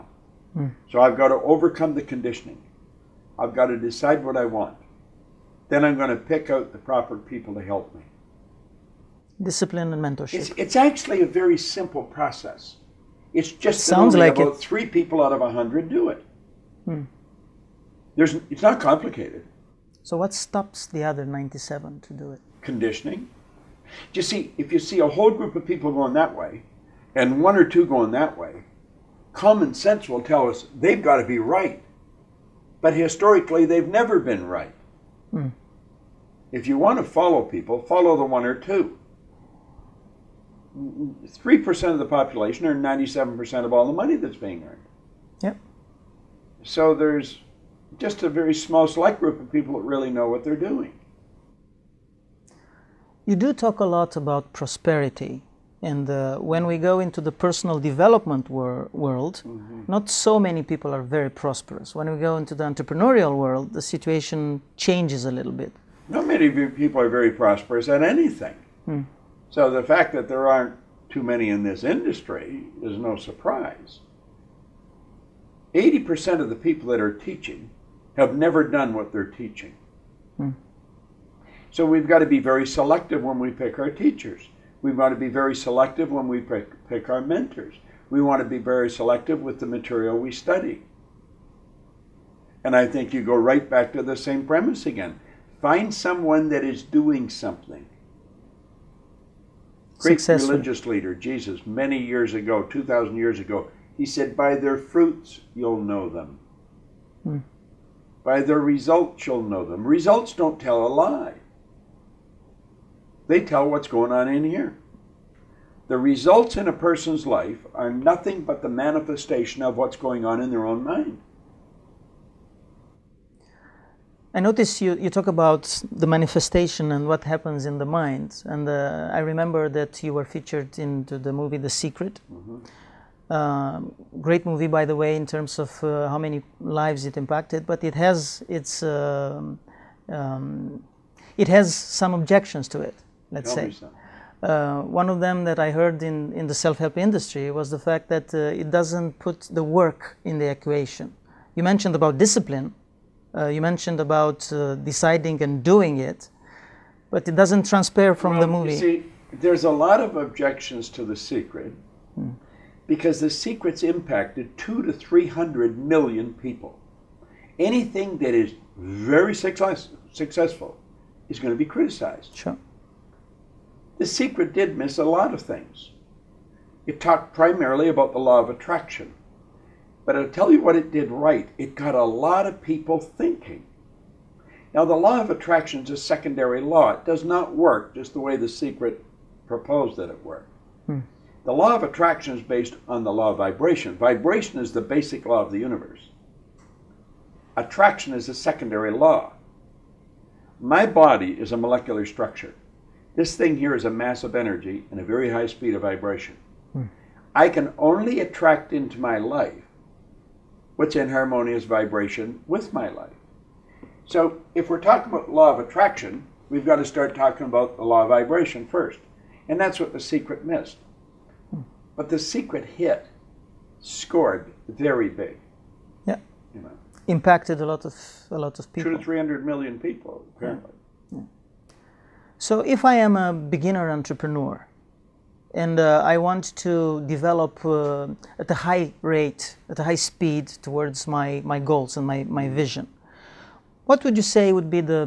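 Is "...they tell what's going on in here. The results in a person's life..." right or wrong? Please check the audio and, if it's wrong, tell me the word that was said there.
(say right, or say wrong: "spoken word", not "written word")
right.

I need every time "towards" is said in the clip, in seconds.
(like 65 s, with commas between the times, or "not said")
240 s.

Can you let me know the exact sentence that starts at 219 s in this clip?
And that's what the secret missed.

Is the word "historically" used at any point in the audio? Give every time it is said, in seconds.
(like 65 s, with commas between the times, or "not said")
32 s.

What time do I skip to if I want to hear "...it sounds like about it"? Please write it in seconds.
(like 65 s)
13 s.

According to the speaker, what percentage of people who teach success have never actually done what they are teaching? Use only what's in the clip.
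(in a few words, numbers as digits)
80%.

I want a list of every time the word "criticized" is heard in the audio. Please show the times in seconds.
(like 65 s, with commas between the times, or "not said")
171 s.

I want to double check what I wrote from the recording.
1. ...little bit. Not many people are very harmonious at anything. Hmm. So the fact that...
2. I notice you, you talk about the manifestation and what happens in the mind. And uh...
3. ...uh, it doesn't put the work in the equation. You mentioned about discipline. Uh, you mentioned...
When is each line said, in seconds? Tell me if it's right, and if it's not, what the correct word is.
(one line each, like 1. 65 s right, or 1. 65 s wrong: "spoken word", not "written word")
1. 65 s wrong: "prosperous", not "harmonious"
2. 124 s right
3. 148 s right.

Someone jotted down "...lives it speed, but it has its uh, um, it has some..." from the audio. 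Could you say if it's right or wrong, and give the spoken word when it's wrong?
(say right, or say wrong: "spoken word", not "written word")
wrong: "impacted", not "speed".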